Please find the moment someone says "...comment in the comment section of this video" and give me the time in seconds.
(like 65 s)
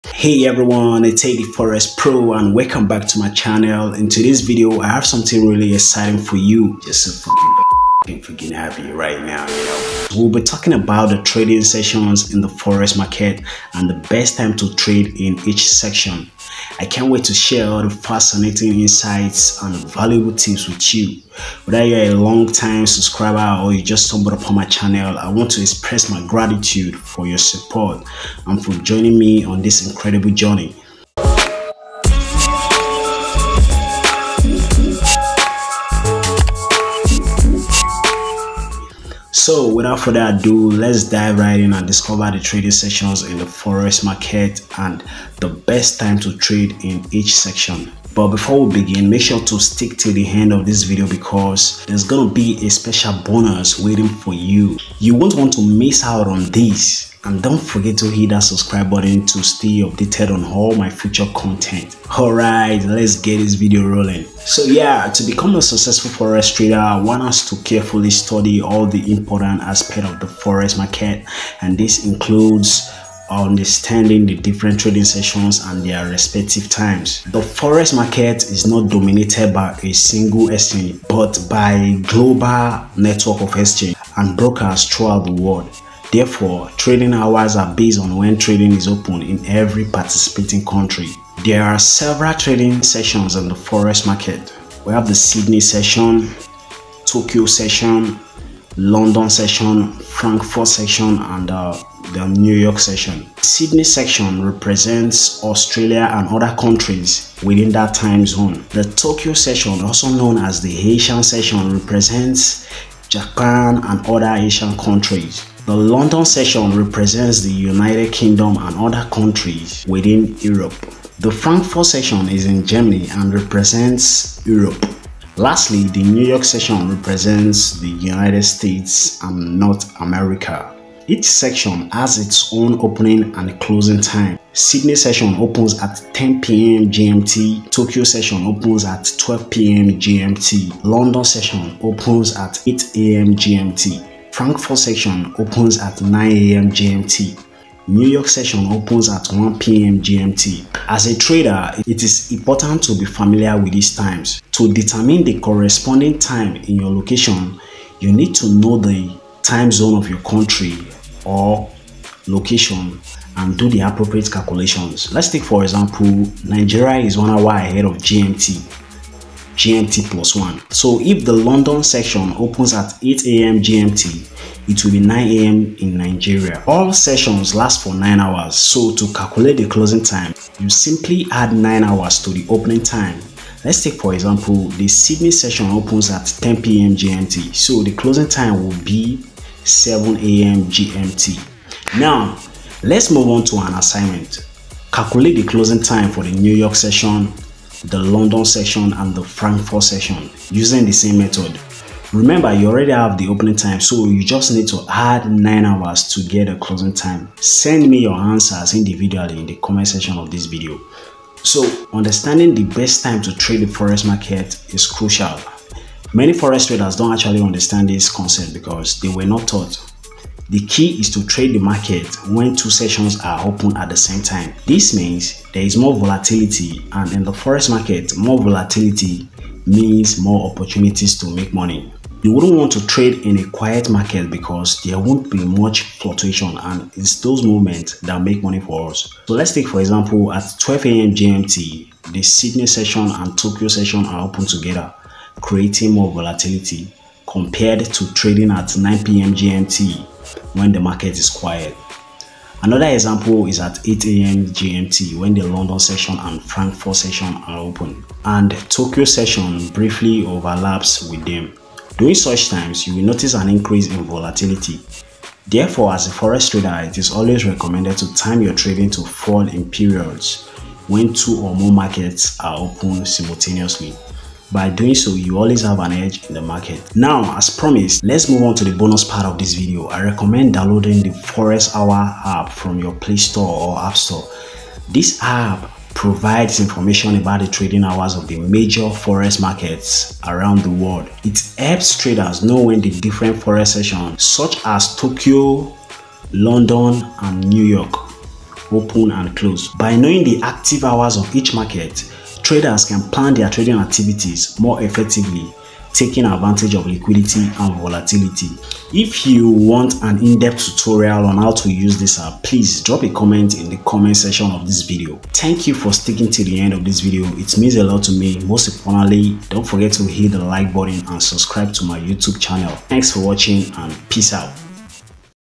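313 s.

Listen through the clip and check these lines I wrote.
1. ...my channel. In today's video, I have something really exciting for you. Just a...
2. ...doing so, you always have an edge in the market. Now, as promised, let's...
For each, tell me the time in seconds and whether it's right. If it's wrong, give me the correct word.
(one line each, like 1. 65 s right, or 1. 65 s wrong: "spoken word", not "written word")
1. 3 s right
2. 274 s right.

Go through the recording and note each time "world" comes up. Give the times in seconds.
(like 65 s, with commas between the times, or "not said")
85 s, 290 s.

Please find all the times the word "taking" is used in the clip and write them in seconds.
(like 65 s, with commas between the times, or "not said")
305 s.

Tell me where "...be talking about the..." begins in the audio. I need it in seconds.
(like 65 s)
10 s.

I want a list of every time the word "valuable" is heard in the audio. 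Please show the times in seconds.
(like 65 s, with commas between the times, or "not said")
19 s.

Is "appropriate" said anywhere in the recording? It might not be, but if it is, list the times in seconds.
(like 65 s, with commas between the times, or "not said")
163 s.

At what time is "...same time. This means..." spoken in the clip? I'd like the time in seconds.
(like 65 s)
223 s.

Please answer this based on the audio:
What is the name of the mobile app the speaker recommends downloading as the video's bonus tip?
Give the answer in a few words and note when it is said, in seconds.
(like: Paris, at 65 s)
Forex Hour, at 281 s.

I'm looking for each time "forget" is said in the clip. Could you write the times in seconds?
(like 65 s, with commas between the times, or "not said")
57 s, 319 s.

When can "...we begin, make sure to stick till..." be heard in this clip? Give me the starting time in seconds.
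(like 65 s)
48 s.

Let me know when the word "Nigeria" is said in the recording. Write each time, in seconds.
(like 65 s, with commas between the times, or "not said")
166 s, 175 s.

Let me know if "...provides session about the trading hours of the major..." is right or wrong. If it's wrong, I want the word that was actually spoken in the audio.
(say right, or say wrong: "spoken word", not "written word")
wrong: "information", not "session".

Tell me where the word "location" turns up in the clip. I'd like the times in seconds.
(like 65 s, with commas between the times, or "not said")
156 s, 162 s.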